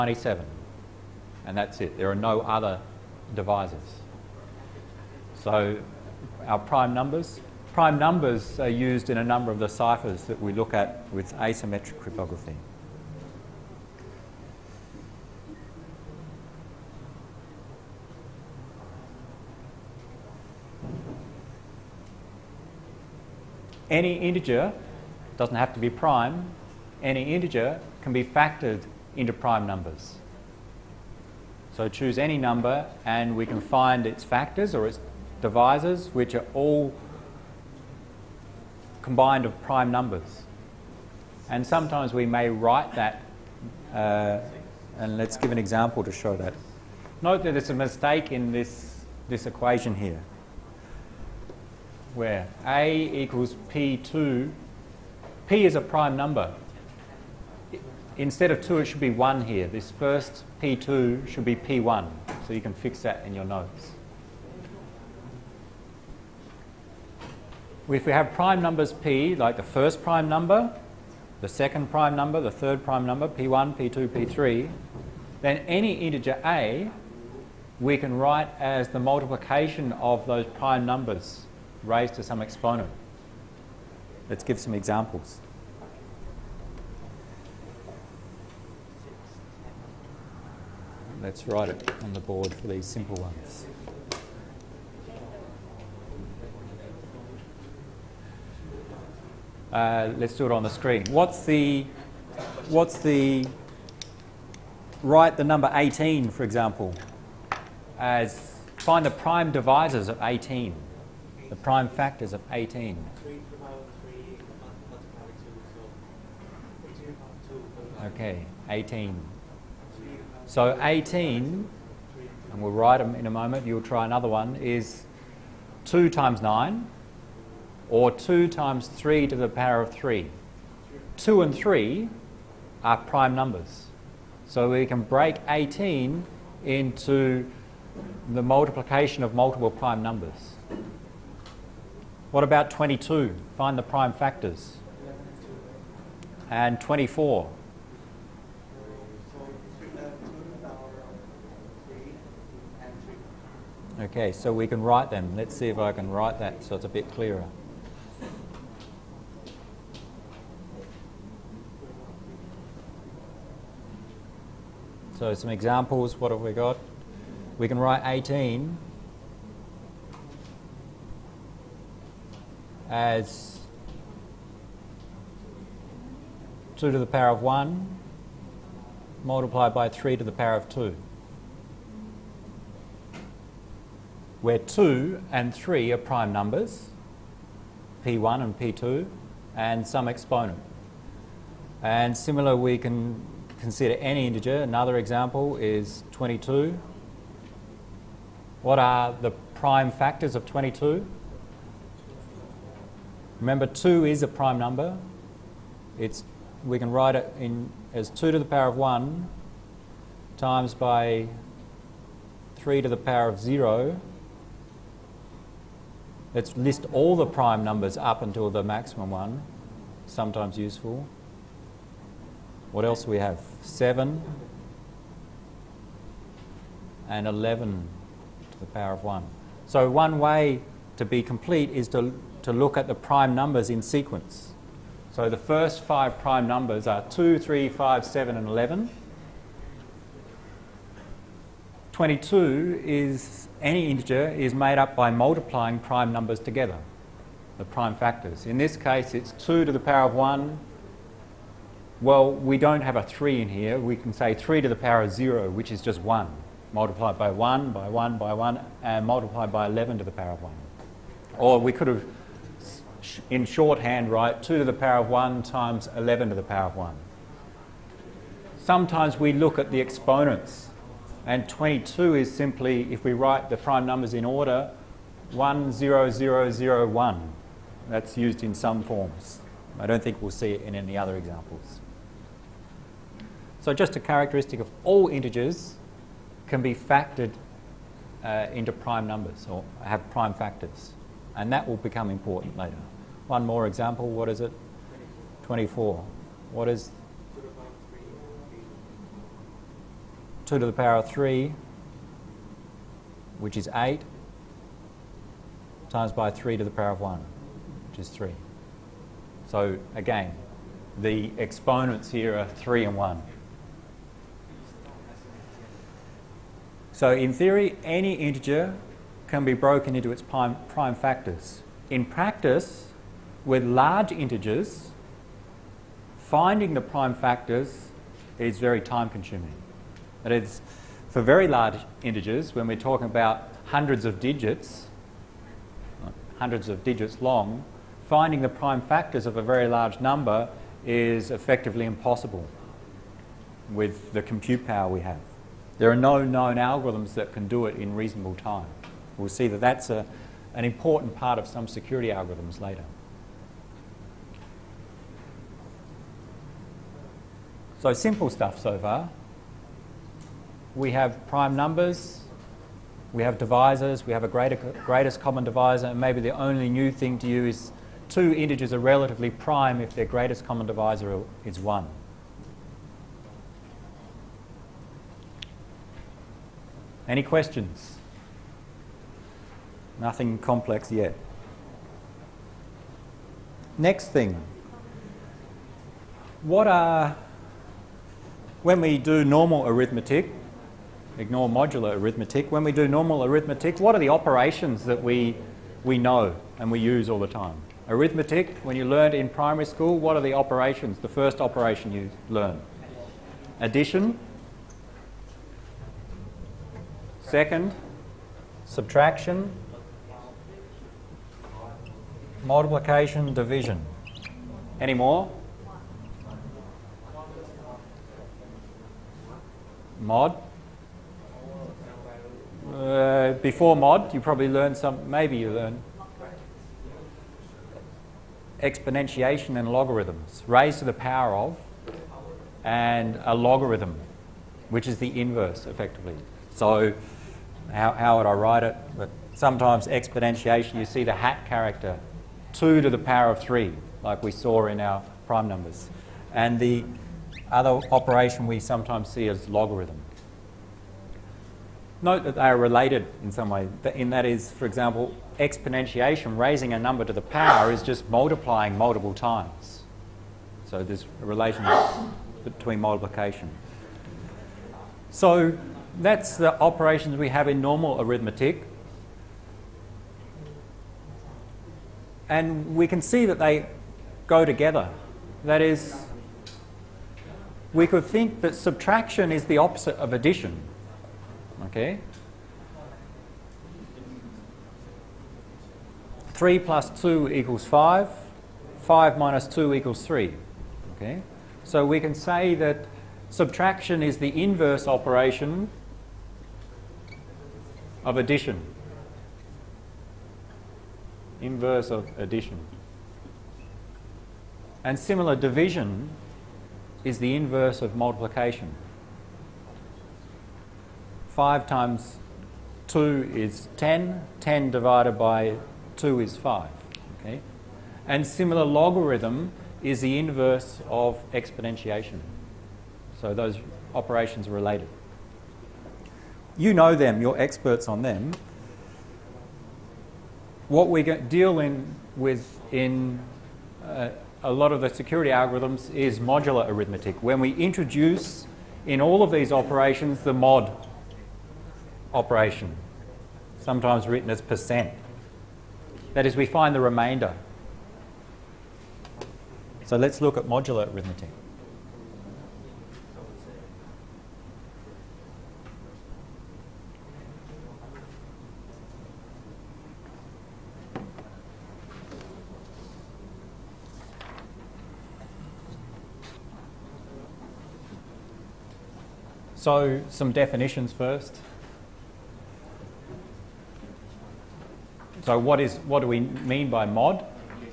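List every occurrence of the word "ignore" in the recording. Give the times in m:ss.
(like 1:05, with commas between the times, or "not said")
6:31.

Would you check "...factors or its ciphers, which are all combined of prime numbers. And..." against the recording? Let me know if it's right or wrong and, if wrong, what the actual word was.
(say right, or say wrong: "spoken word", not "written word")
wrong: "divisors", not "ciphers".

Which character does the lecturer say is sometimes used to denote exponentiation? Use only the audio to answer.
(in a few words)
the hat character.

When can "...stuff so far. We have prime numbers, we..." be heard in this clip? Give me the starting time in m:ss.
5:58.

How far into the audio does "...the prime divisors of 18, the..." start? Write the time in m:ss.
1:49.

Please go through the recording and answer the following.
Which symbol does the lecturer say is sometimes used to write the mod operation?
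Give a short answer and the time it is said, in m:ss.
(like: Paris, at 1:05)
percent, at 9:04.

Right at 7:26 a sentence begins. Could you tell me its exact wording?
And the other operation we sometimes see as logarithm.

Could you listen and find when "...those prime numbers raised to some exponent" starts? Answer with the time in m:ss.
1:20.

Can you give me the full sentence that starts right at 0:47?
Note that there's a mistake in this, this equation here, where A equals P2.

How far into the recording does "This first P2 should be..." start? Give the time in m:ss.
0:59.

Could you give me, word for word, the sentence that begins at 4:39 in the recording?
I don't think we'll see it in any other examples.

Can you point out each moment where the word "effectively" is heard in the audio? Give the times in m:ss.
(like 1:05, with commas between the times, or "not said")
5:41, 7:15.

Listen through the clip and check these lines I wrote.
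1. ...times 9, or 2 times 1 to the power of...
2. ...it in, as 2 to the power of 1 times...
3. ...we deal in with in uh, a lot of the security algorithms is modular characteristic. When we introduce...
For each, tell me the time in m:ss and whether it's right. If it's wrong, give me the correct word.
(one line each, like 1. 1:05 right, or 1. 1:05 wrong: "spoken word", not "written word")
1. 2:06 wrong: "3", not "1"
2. 3:27 right
3. 8:50 wrong: "arithmetic", not "characteristic".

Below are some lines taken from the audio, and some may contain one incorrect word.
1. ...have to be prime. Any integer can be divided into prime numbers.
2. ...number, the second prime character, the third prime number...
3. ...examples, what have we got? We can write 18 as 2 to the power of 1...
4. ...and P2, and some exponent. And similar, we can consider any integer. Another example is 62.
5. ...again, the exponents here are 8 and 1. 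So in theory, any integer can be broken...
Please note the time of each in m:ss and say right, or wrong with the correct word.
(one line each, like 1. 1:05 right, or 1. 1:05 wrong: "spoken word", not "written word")
1. 0:25 wrong: "factored", not "divided"
2. 1:10 wrong: "number", not "character"
3. 2:45 right
4. 3:08 wrong: "22", not "62"
5. 5:09 wrong: "3", not "8".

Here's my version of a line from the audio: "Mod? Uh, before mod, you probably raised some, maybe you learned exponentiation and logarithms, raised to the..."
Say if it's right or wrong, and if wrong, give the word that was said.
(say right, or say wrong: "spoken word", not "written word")
wrong: "learned", not "raised".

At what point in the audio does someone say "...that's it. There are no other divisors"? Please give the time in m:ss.
0:01.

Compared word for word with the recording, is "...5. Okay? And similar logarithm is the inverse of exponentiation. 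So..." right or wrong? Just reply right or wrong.
right.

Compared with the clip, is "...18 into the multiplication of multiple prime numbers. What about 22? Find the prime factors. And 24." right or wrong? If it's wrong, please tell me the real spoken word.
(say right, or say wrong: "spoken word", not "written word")
right.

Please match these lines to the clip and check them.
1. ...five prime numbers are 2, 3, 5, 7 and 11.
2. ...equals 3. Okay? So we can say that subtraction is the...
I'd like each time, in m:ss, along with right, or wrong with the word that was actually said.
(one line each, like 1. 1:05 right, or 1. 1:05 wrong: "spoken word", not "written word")
1. 3:55 right
2. 8:09 right.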